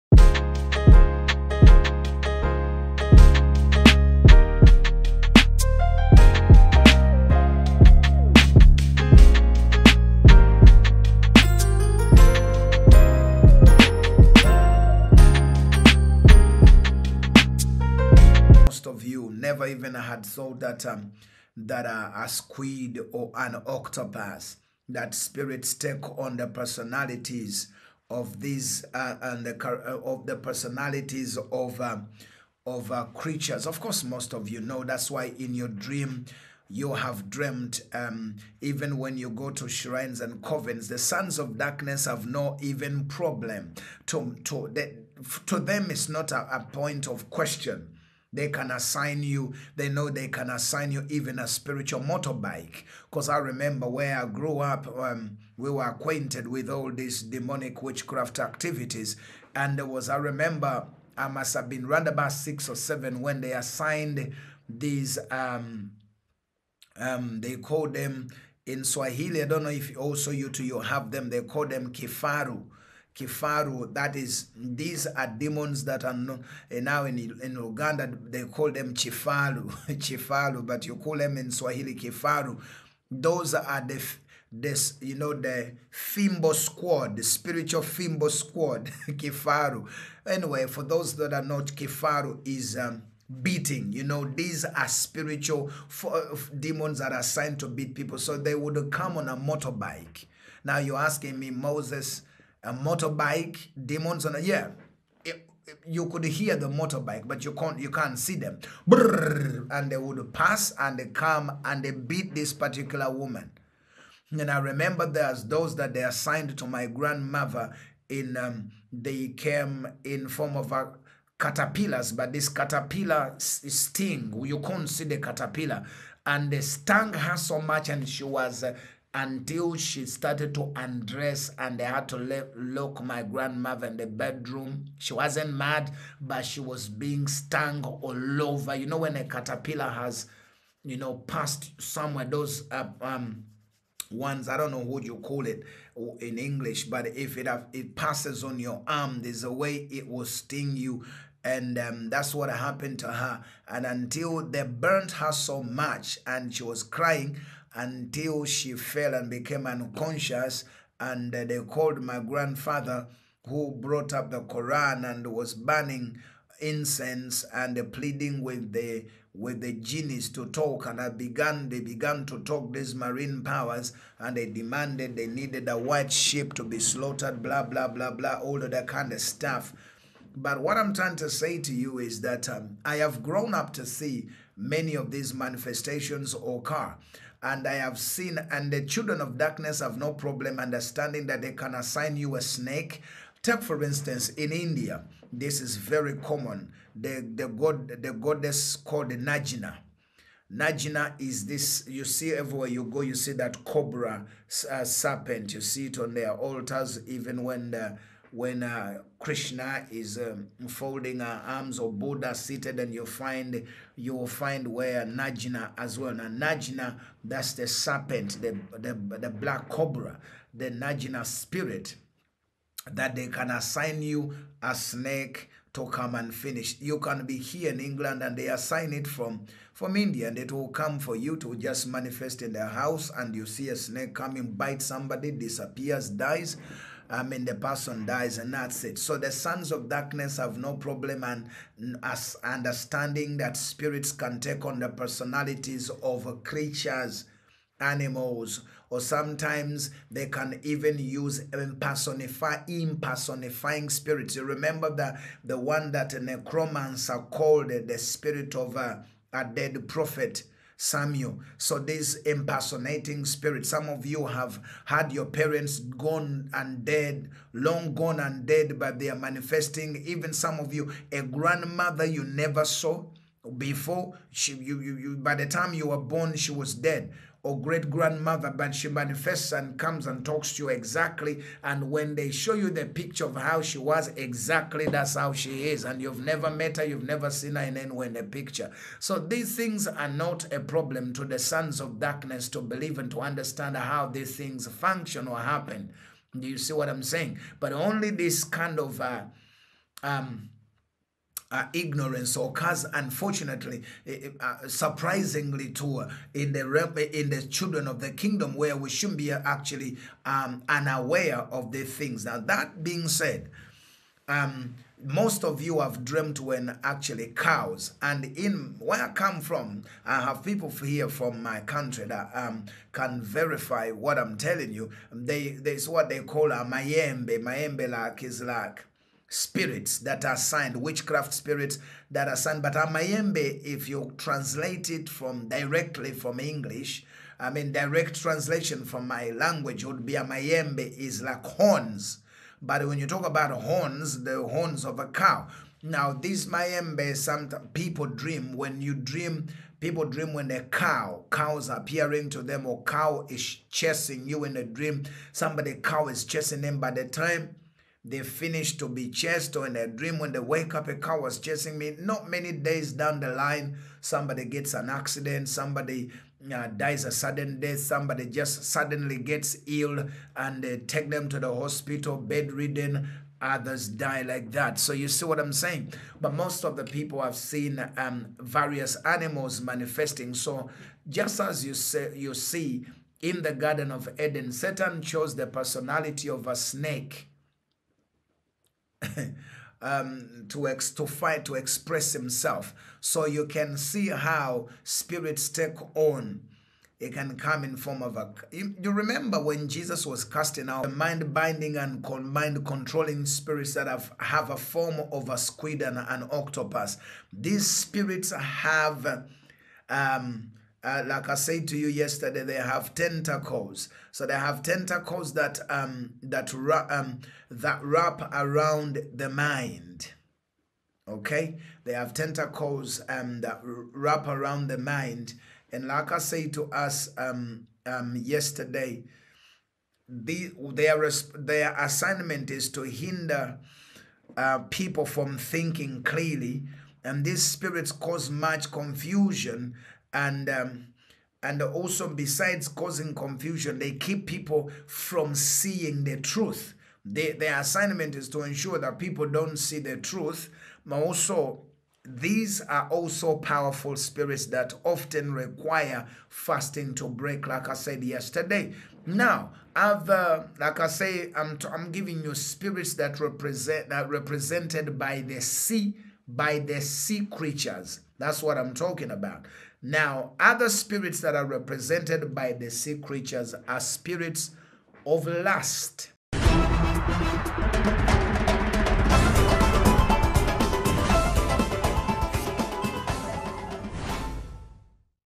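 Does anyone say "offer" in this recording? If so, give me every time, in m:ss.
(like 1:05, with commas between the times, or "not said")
not said.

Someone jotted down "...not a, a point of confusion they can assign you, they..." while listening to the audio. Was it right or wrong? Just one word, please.
wrong.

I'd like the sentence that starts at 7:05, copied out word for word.
And like I said to us um, um, yesterday, the, their their assignment is to hinder uh, people from thinking clearly.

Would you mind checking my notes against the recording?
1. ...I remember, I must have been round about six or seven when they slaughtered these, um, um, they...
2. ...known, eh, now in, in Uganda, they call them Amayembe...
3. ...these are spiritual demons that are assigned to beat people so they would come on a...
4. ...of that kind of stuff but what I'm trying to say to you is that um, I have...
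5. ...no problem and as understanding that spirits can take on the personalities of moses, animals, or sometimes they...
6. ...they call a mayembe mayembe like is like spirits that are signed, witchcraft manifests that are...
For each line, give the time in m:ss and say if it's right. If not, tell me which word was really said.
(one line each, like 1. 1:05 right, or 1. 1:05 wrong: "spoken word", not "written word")
1. 1:00 wrong: "assigned", not "slaughtered"
2. 1:16 wrong: "Chifaru", not "Amayembe"
3. 1:34 right
4. 2:58 right
5. 4:00 wrong: "creatures", not "moses"
6. 5:26 wrong: "spirits", not "manifests".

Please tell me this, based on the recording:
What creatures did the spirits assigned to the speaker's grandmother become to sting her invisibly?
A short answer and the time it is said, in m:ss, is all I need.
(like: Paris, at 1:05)
caterpillars, at 2:01.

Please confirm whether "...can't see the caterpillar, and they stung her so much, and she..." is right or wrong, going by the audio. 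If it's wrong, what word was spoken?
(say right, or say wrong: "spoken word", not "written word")
right.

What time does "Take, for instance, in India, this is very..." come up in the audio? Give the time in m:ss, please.
3:13.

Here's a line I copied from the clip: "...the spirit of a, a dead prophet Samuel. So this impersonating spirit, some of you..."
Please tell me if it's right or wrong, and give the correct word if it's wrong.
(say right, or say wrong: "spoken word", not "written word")
right.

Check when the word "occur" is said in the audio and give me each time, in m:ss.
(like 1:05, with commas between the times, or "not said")
3:06, 5:02.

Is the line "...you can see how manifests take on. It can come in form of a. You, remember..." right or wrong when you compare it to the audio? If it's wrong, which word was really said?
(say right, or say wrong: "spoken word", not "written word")
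wrong: "spirits", not "manifests".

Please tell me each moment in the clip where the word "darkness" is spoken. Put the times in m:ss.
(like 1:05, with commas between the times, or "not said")
0:41, 3:09, 3:59, 4:51.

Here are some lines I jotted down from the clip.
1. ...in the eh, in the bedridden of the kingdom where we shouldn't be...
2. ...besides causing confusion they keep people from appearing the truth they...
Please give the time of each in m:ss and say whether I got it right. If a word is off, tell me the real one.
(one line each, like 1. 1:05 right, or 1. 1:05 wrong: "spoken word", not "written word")
1. 5:06 wrong: "children", not "bedridden"
2. 7:22 wrong: "seeing", not "appearing".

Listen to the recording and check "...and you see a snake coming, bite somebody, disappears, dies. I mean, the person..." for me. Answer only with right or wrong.
right.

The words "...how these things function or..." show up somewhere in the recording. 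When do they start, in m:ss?
4:53.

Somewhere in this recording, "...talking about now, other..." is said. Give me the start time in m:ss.
7:48.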